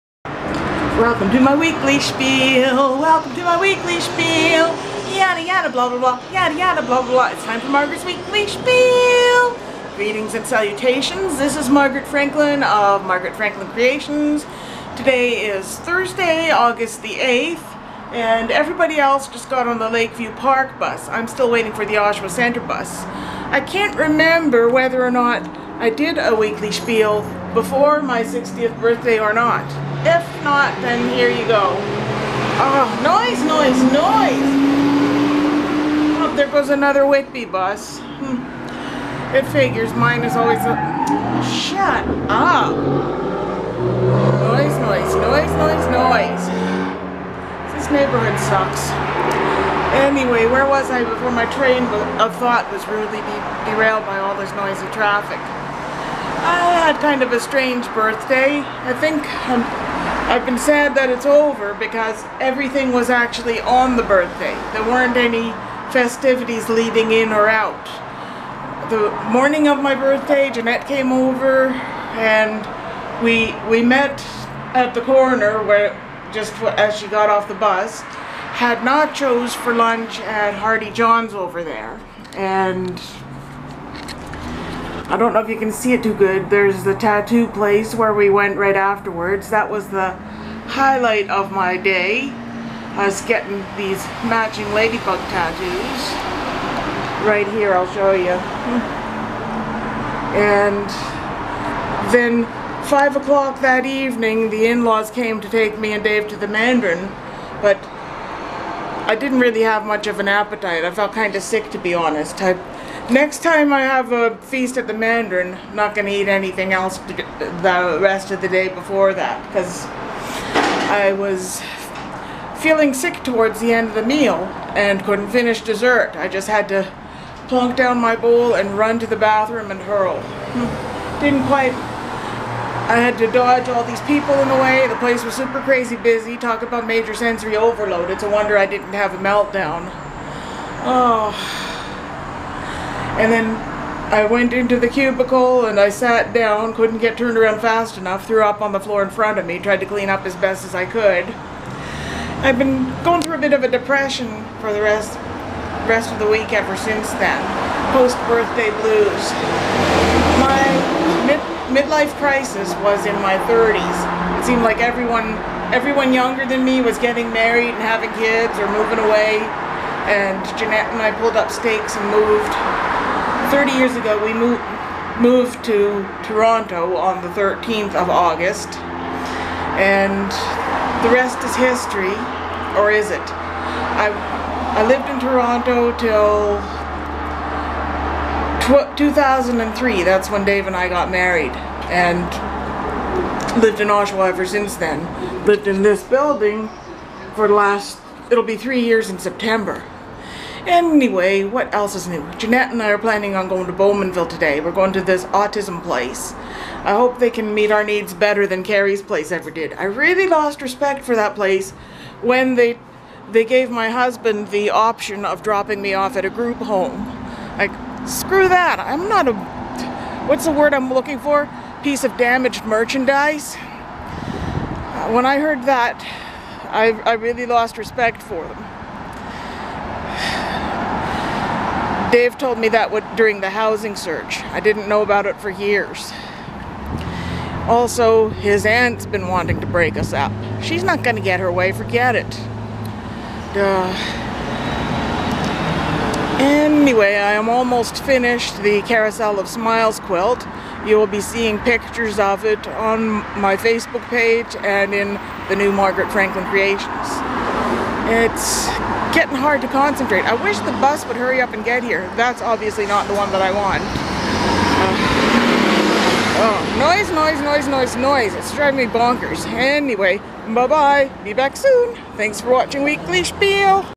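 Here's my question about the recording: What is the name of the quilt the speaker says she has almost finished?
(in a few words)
Carousel of Smiles.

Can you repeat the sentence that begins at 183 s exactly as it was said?
I, I lived in Toronto till 2003.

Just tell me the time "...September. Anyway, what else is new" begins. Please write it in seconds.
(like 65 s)
199 s.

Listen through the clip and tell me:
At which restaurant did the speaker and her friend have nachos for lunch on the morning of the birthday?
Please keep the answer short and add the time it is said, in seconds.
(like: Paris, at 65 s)
Hardy John's, at 80 s.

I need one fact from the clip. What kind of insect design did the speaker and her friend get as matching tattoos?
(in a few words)
Ladybug.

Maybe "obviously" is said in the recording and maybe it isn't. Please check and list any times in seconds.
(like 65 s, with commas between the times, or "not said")
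262 s.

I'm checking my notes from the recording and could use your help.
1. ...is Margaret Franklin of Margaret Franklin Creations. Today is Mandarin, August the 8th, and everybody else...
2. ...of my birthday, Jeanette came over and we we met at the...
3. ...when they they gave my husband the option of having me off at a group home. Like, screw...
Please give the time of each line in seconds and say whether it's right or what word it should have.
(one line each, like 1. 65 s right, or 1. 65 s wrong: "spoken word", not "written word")
1. 11 s wrong: "Thursday", not "Mandarin"
2. 69 s right
3. 212 s wrong: "dropping", not "having".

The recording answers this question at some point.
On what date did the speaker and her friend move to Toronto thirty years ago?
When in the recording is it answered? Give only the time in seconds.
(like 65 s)
177 s.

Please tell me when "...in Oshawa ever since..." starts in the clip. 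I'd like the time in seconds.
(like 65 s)
193 s.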